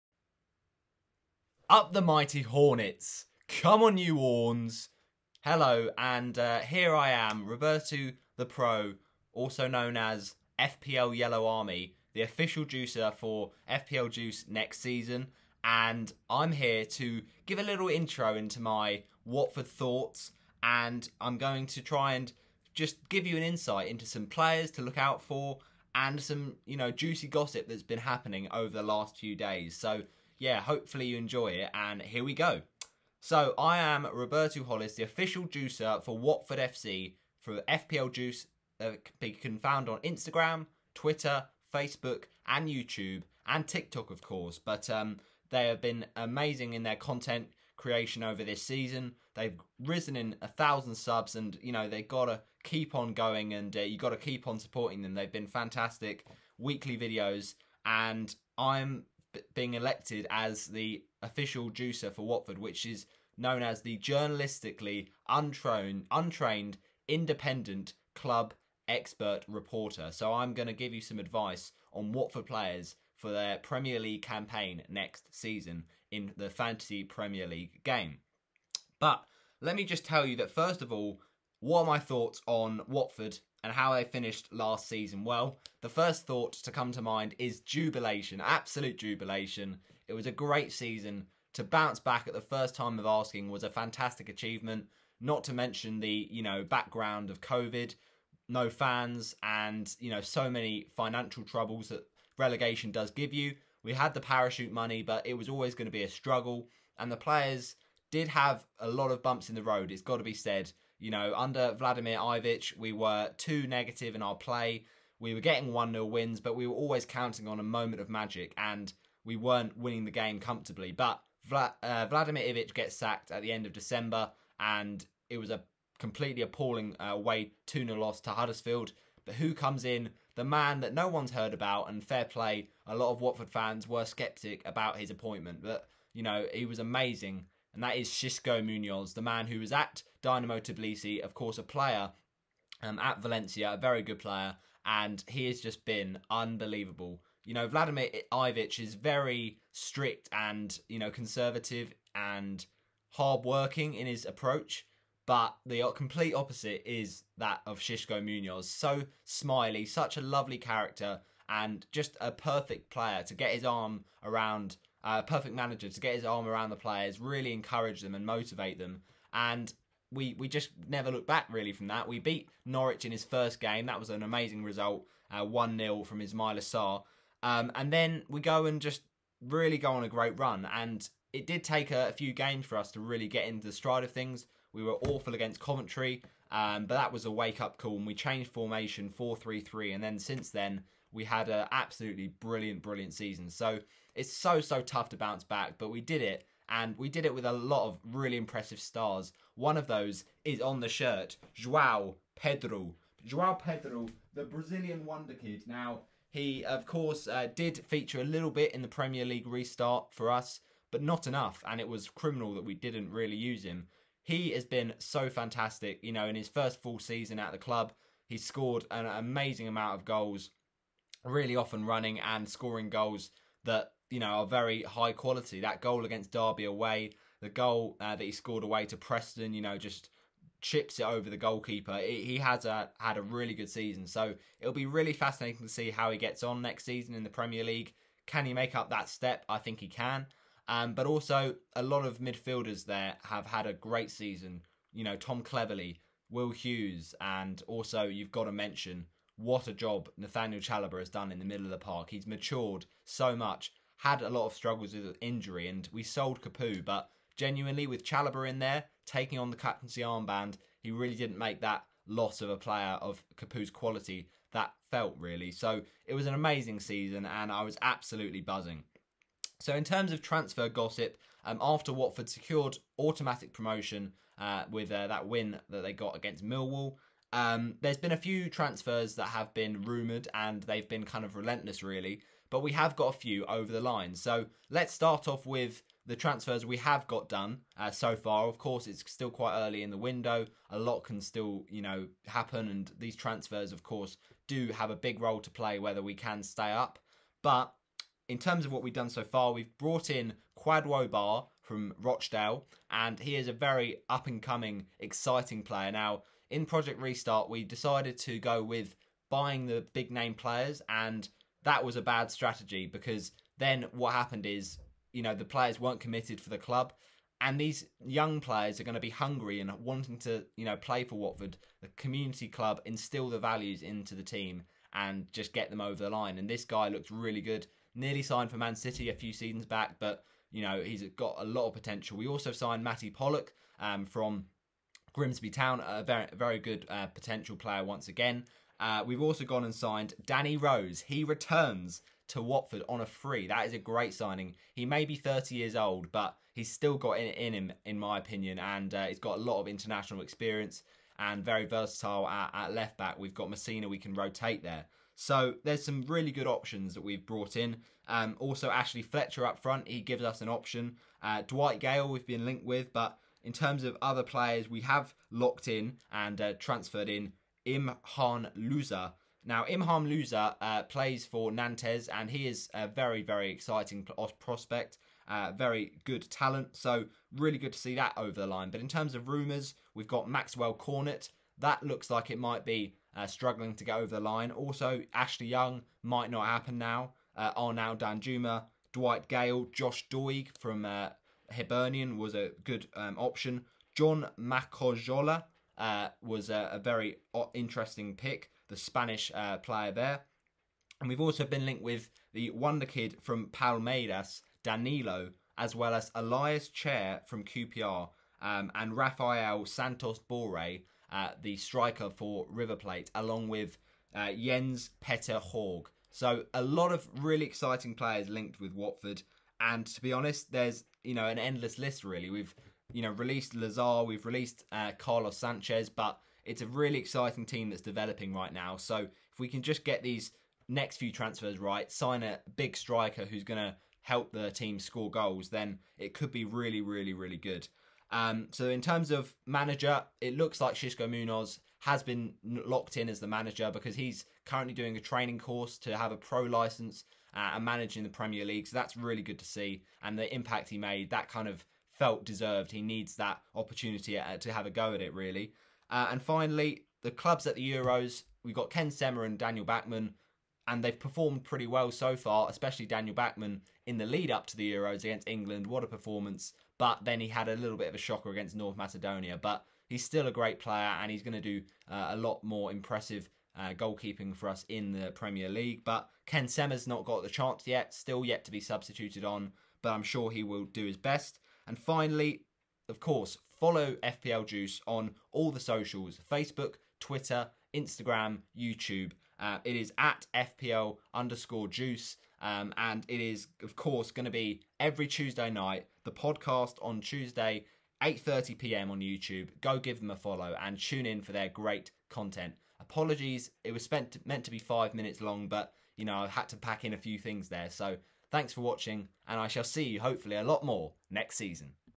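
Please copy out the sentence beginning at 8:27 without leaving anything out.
So thanks for watching, and I shall see you, hopefully, a lot more next season.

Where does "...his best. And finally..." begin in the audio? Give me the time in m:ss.
8:00.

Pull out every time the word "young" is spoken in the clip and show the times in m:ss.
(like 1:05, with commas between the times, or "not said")
5:18, 6:25.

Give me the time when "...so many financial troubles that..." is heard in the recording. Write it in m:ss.
1:40.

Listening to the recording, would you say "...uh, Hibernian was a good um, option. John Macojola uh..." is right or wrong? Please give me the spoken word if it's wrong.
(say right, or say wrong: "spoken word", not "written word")
right.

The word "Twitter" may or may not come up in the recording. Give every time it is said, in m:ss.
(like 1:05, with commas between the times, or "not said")
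0:40, 8:06.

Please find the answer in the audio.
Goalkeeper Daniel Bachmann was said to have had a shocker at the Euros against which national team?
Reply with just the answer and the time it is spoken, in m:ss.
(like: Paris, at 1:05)
North Macedonia, at 7:48.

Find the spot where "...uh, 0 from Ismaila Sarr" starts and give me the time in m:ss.
2:55.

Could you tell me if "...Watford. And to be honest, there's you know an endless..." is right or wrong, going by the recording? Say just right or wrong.
right.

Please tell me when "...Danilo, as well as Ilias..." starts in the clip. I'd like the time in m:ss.
6:44.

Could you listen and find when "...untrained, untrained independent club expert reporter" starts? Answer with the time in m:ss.
1:05.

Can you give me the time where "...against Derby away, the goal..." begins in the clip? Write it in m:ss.
3:46.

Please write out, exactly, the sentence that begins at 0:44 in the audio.
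But um, they have been amazing in their content creation over this season.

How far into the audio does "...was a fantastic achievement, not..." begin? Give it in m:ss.
1:33.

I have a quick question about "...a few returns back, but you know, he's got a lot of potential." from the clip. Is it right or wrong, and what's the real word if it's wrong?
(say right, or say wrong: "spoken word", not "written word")
wrong: "seasons", not "returns".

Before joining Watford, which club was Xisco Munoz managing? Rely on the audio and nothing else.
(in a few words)
Dynamo Tbilisi.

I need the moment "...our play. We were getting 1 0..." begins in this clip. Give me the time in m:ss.
1:54.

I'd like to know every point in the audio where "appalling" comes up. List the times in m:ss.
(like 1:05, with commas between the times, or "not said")
2:06.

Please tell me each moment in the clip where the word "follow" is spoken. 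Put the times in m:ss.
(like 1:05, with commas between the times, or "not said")
8:03, 8:20.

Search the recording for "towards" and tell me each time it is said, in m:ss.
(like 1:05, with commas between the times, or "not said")
not said.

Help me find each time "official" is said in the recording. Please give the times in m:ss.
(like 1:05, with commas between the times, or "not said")
0:12, 0:35, 1:01.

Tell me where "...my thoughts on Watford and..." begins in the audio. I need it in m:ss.
1:21.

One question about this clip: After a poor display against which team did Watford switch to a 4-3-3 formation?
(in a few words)
Coventry.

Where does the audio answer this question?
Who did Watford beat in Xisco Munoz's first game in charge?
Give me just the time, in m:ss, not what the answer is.
2:52.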